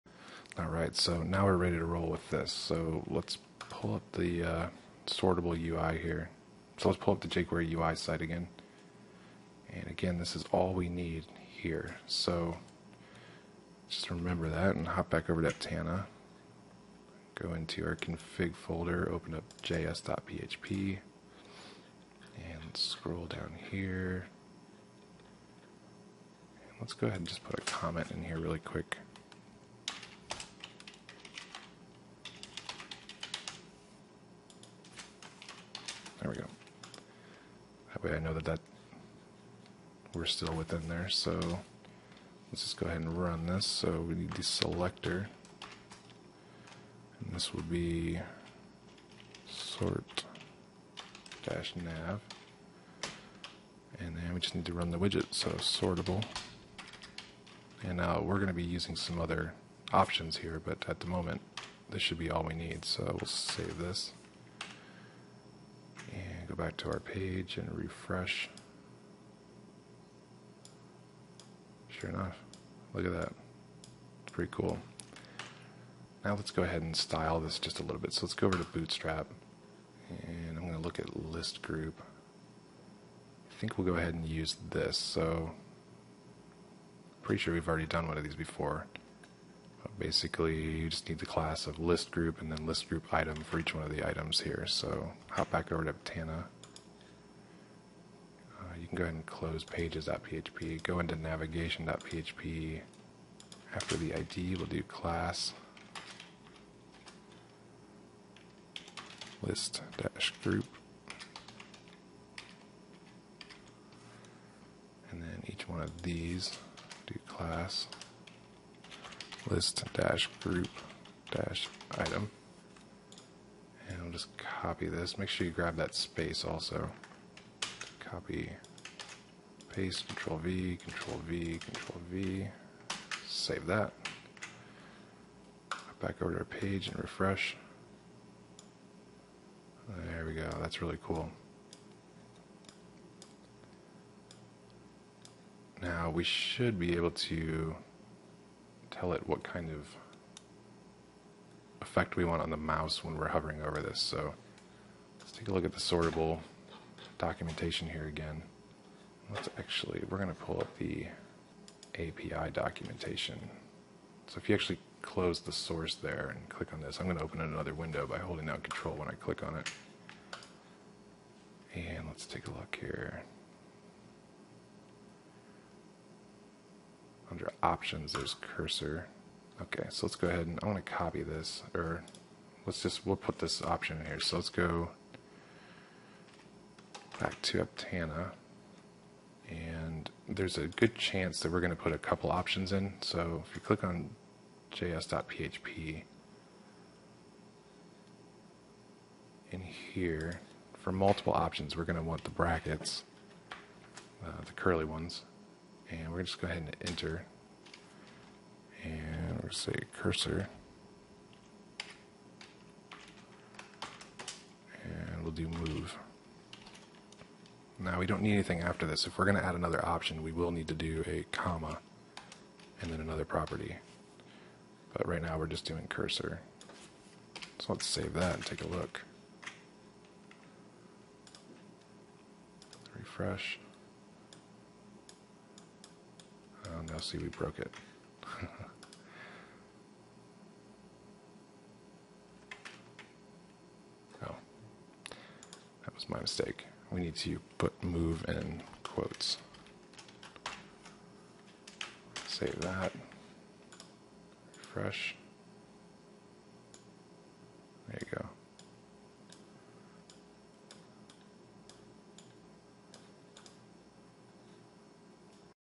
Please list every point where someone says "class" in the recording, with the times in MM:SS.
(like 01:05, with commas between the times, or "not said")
01:31, 01:44, 01:57.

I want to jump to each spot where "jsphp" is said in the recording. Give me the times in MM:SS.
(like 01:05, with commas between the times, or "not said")
00:19, 03:14.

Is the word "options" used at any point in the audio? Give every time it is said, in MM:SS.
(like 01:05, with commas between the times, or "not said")
00:59, 02:57, 03:03, 03:12, 03:21, 03:39.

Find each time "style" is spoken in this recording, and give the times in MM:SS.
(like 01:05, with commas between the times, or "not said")
01:16.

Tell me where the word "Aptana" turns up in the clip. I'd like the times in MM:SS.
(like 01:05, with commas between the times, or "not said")
00:15, 01:35, 03:07.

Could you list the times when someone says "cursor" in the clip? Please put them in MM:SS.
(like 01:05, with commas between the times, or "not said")
02:58, 03:29, 03:45.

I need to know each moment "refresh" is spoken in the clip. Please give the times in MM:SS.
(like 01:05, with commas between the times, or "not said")
01:07, 02:16, 03:52, 04:14.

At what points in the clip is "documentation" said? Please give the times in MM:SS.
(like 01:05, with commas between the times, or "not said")
02:37, 02:42.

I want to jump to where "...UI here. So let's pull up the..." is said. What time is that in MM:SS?
00:05.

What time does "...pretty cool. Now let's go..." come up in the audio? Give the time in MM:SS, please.
01:14.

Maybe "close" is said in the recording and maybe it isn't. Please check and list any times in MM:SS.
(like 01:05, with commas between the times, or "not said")
01:39, 02:45.